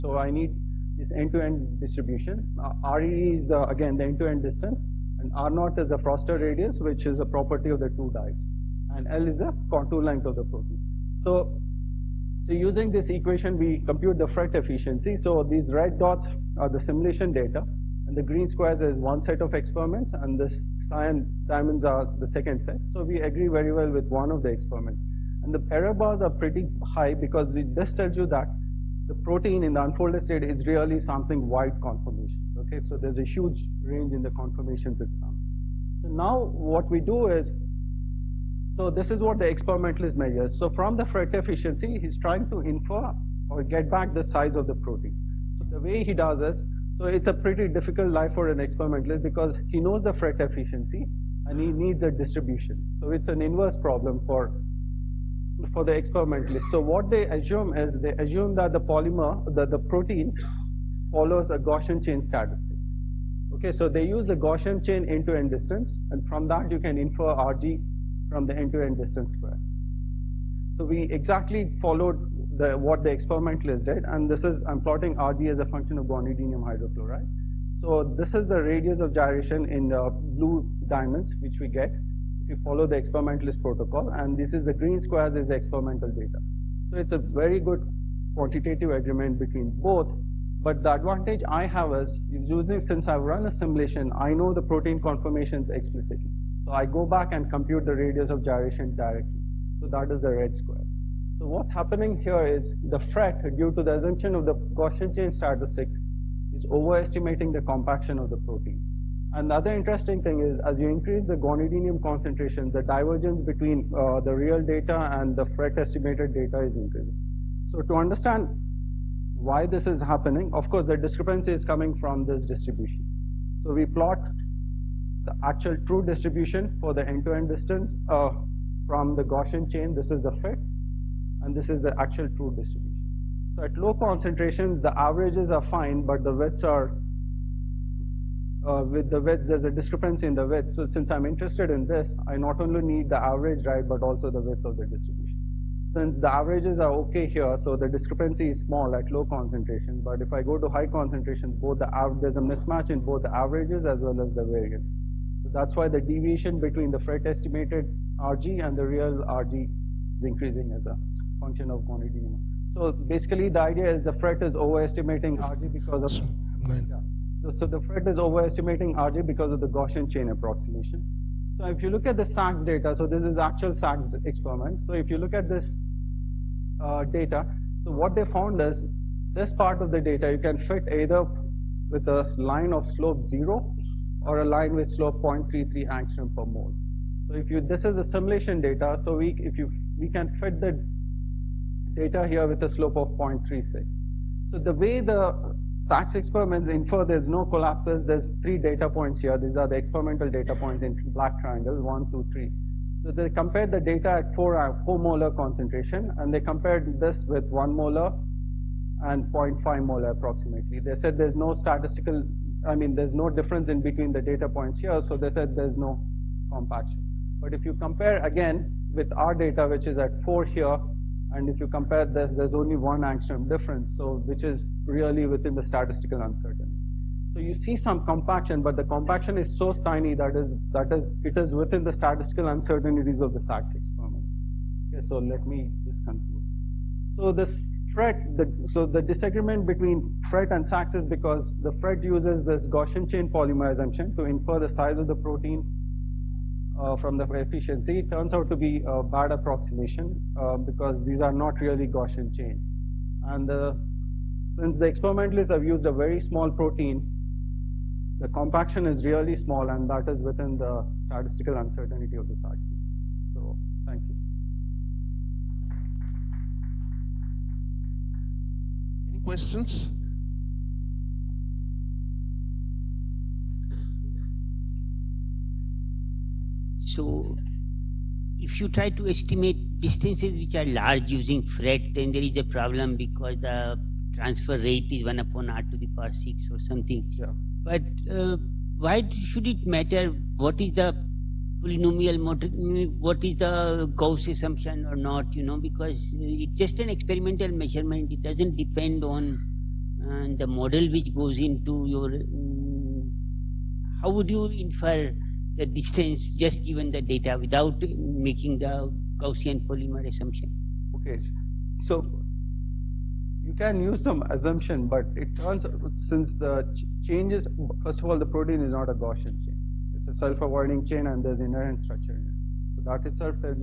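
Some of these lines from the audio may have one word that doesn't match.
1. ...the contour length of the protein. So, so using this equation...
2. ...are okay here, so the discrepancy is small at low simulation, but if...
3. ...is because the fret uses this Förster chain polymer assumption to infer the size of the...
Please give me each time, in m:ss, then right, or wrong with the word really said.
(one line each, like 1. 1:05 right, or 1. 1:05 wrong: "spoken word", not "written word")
1. 0:09 right
2. 2:26 wrong: "concentration", not "simulation"
3. 4:00 wrong: "Gaussian", not "Förster".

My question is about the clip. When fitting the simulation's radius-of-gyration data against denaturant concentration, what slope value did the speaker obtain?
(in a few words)
0.36.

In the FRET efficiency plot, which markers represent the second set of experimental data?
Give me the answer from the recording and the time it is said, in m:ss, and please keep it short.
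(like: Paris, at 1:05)
cyan diamonds, at 0:20.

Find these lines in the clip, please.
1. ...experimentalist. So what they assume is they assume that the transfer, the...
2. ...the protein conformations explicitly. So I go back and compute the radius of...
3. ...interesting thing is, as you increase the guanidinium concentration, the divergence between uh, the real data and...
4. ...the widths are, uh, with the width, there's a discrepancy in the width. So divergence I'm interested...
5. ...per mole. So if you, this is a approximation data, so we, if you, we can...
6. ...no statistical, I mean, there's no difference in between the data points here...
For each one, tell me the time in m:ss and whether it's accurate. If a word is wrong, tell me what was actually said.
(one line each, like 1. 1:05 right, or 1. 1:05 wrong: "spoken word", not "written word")
1. 0:55 wrong: "polymer", not "transfer"
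2. 1:34 right
3. 1:49 right
4. 2:16 wrong: "since", not "divergence"
5. 3:06 wrong: "simulation", not "approximation"
6. 3:31 right.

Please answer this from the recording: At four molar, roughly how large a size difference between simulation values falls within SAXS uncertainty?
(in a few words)
1 angstrom.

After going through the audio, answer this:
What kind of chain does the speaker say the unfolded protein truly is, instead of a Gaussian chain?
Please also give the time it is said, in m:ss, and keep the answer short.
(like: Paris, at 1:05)
self-avoiding chain, at 5:20.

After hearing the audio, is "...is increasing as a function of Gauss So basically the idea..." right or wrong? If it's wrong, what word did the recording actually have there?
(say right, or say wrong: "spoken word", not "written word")
wrong: "Gonnet", not "Gauss".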